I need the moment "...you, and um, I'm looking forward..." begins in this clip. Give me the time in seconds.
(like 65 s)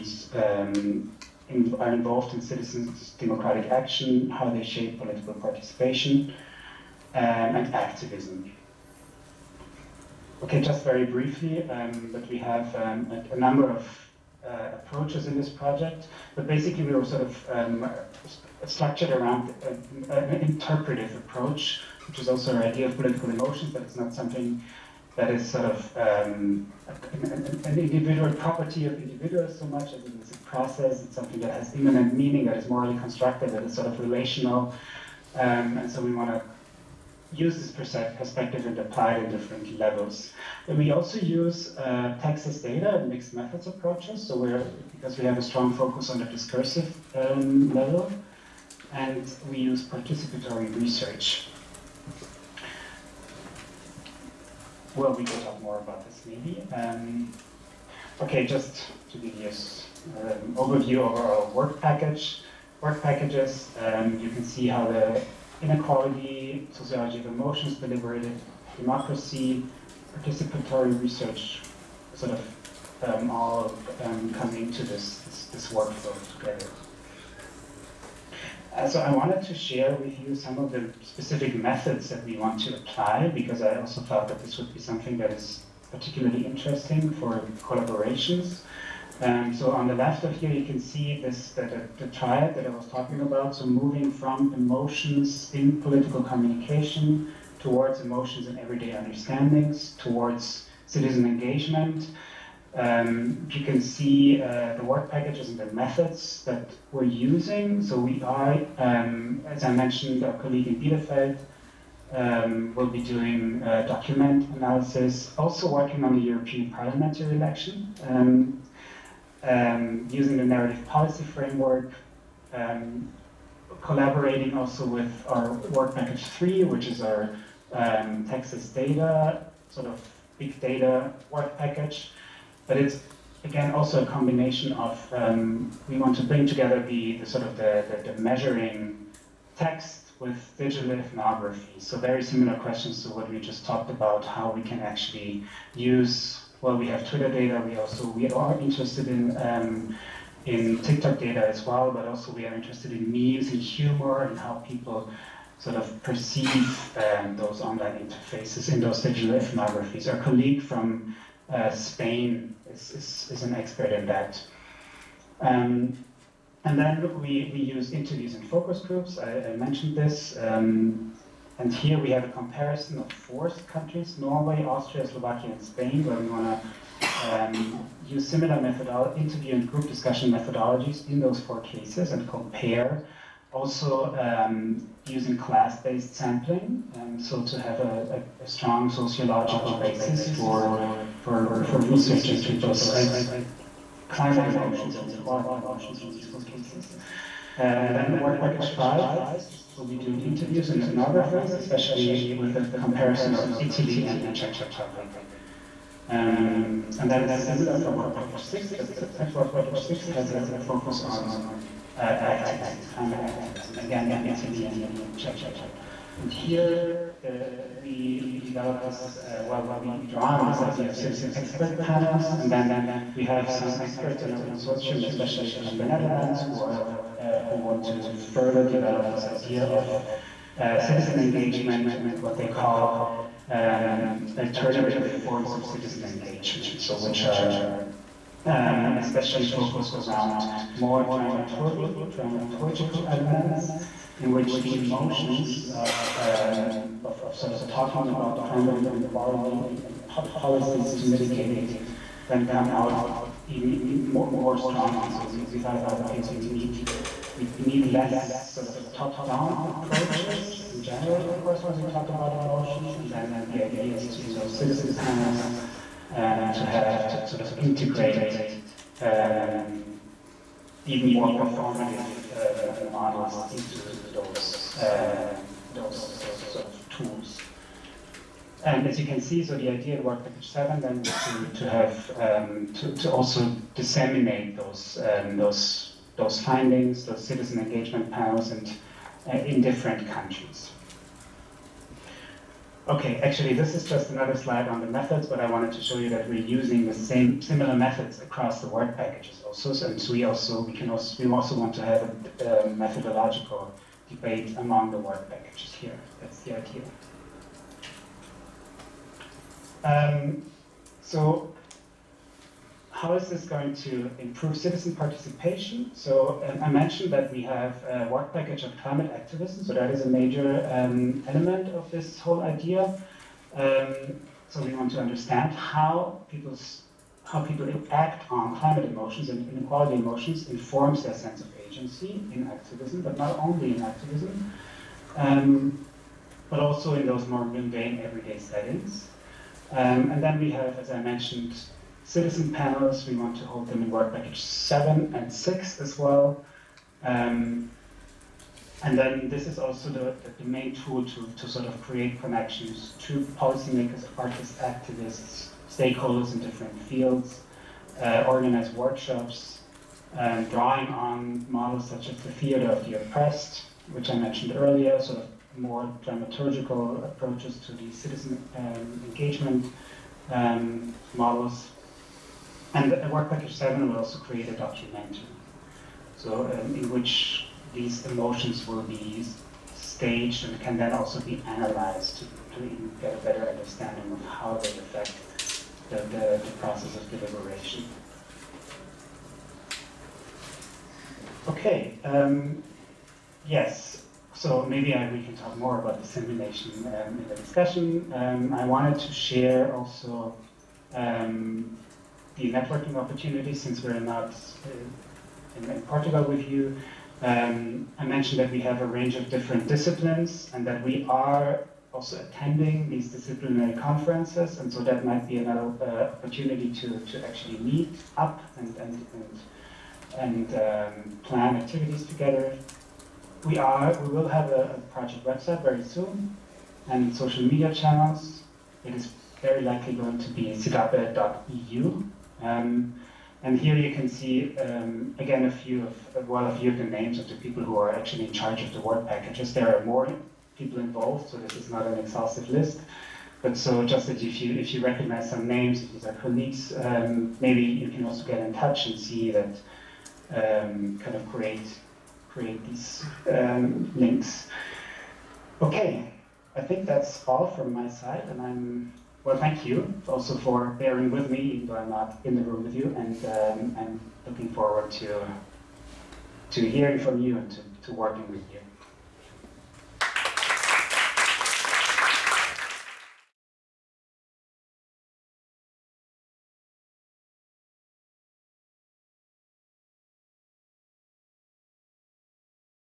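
462 s.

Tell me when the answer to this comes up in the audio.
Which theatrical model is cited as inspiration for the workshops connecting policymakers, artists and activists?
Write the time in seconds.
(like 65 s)
362 s.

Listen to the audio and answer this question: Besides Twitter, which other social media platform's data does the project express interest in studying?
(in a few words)
TikTok.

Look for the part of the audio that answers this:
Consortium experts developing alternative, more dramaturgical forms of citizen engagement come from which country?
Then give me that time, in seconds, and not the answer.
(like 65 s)
225 s.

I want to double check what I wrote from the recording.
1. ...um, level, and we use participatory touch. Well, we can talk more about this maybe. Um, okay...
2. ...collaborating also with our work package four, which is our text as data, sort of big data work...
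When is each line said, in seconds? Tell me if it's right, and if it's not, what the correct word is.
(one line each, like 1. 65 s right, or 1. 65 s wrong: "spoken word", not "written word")
1. 47 s wrong: "research", not "touch"
2. 123 s wrong: "three", not "four".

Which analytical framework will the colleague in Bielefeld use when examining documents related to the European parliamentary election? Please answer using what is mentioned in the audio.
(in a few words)
narrative policy framework.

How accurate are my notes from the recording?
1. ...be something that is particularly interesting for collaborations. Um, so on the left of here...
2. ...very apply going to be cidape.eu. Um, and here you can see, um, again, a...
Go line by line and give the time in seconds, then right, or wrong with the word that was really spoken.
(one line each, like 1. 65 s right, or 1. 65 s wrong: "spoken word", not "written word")
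1. 84 s right
2. 429 s wrong: "likely", not "apply".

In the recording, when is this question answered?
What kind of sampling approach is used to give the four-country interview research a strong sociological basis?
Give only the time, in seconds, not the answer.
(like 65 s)
185 s.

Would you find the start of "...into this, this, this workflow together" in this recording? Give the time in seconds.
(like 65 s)
74 s.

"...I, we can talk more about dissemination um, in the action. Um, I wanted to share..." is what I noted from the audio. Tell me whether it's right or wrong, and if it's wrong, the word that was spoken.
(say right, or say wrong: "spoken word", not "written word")
wrong: "discussion", not "action".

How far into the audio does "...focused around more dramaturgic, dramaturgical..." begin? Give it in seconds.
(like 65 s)
239 s.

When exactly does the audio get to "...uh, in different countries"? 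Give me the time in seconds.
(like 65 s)
289 s.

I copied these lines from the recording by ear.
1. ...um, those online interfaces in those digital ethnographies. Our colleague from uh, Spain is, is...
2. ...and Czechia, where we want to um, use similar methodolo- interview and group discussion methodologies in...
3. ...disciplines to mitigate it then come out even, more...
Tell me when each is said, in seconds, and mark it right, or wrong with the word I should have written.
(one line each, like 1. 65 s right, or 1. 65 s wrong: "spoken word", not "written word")
1. 156 s right
2. 175 s wrong: "Spain", not "Czechia"
3. 250 s wrong: "policies", not "disciplines".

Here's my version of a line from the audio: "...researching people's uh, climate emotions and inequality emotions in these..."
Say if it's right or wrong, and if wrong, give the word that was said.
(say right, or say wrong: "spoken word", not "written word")
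right.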